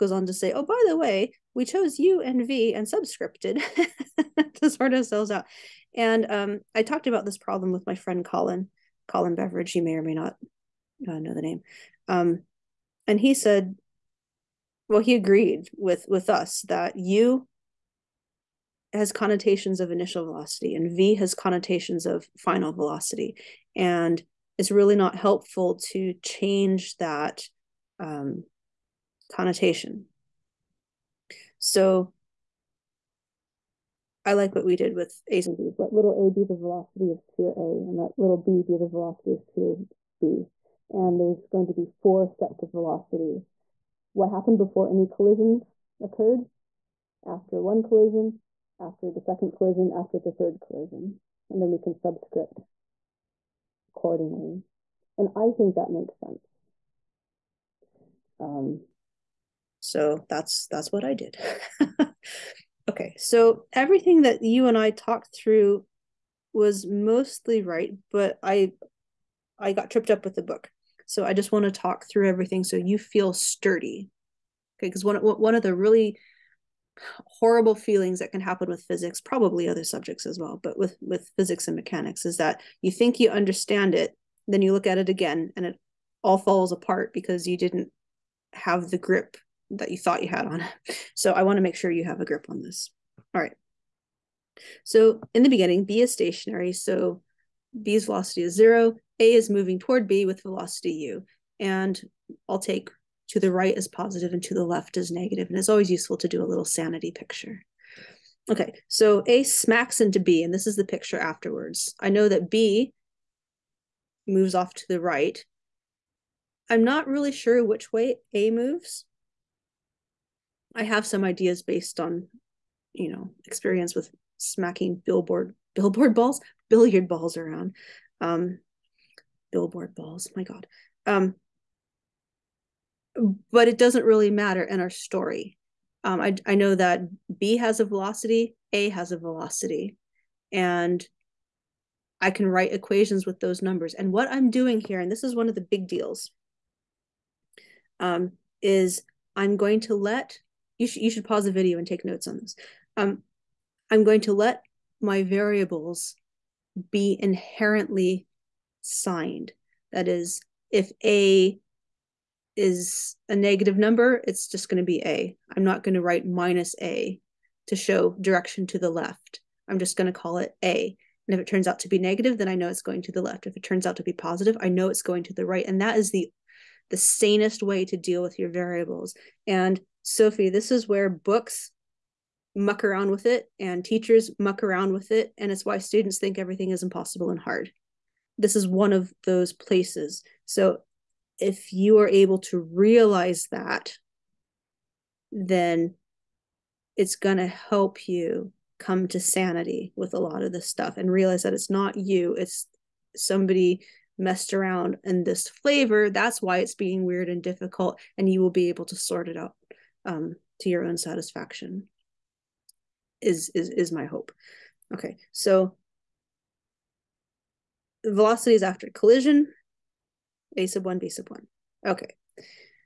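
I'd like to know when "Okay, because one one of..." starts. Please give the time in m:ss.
1:14.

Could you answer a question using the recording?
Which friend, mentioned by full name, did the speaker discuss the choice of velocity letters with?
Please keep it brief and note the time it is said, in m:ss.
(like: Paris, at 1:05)
Colin Beveridge, at 0:09.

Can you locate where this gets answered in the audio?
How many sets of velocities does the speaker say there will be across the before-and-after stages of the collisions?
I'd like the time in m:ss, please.
0:41.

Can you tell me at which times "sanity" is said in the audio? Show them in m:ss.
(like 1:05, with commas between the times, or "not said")
1:46, 3:19.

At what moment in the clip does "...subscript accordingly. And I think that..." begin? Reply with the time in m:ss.
0:51.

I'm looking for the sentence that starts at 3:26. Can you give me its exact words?
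That's why it's being weird and difficult, and you will be able to sort it out um, to your own satisfaction.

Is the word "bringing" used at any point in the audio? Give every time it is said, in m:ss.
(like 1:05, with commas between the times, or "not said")
not said.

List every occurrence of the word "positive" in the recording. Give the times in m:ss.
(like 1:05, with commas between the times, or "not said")
1:43, 2:54.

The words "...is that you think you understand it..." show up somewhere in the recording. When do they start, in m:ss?
1:22.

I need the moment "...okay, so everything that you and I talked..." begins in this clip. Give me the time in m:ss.
1:02.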